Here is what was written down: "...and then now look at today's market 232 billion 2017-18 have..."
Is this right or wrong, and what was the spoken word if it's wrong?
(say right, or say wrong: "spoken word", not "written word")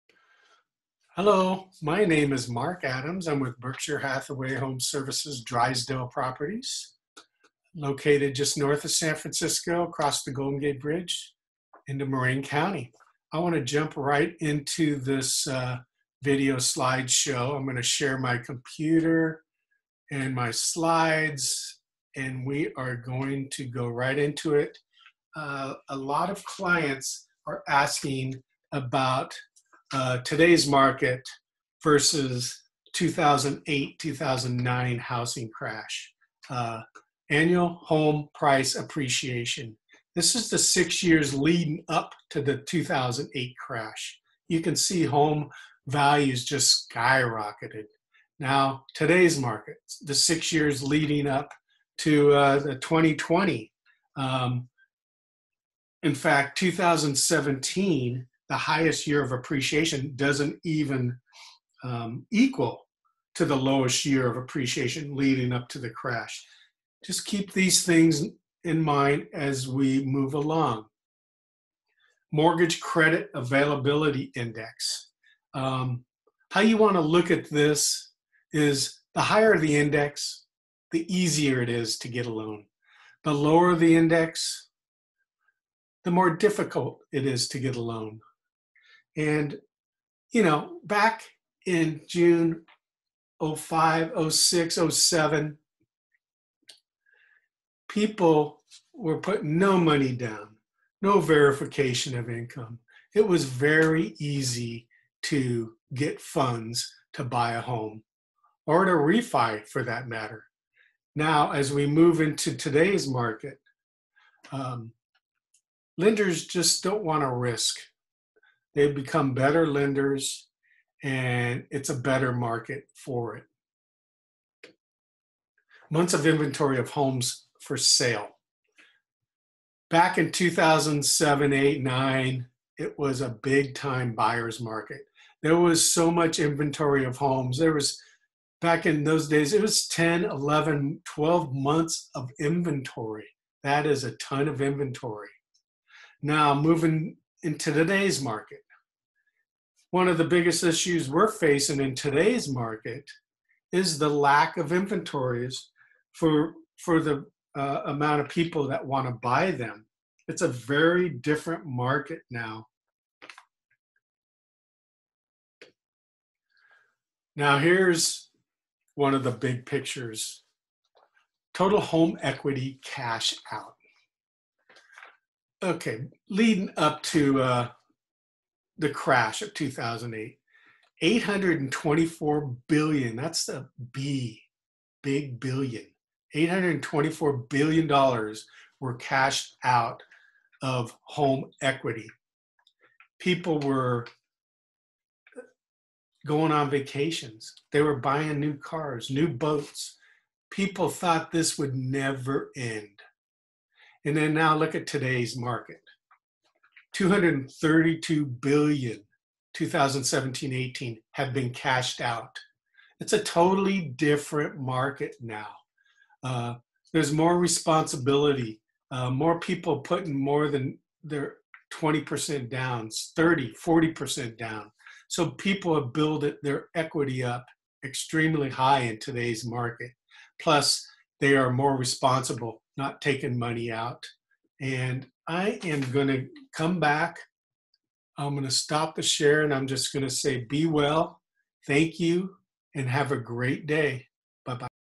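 right.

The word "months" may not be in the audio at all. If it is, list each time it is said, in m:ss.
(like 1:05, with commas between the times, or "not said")
2:05, 2:21.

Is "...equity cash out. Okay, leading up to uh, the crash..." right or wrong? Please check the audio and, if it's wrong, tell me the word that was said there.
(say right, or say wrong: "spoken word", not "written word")
right.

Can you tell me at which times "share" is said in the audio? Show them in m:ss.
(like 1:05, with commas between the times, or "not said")
0:17, 3:59.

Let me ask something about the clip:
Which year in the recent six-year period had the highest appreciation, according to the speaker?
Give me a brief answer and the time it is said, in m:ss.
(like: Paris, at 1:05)
2017, at 0:56.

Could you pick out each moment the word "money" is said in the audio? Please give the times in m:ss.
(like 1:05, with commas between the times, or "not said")
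1:39, 3:53.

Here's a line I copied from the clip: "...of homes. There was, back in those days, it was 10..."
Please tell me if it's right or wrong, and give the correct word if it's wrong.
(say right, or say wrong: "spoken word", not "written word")
right.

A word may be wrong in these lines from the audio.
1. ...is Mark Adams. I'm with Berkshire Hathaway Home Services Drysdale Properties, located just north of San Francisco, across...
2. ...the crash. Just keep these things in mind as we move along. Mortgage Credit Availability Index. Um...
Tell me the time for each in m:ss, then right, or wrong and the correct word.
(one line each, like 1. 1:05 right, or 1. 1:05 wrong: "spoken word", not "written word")
1. 0:02 right
2. 1:05 right.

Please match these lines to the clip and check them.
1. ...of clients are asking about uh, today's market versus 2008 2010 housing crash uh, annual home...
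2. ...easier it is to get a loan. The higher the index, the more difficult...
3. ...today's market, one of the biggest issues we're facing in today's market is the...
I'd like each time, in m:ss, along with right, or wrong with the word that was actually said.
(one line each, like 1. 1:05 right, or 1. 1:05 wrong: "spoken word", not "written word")
1. 0:26 wrong: "2009", not "2010"
2. 1:21 wrong: "lower", not "higher"
3. 2:27 right.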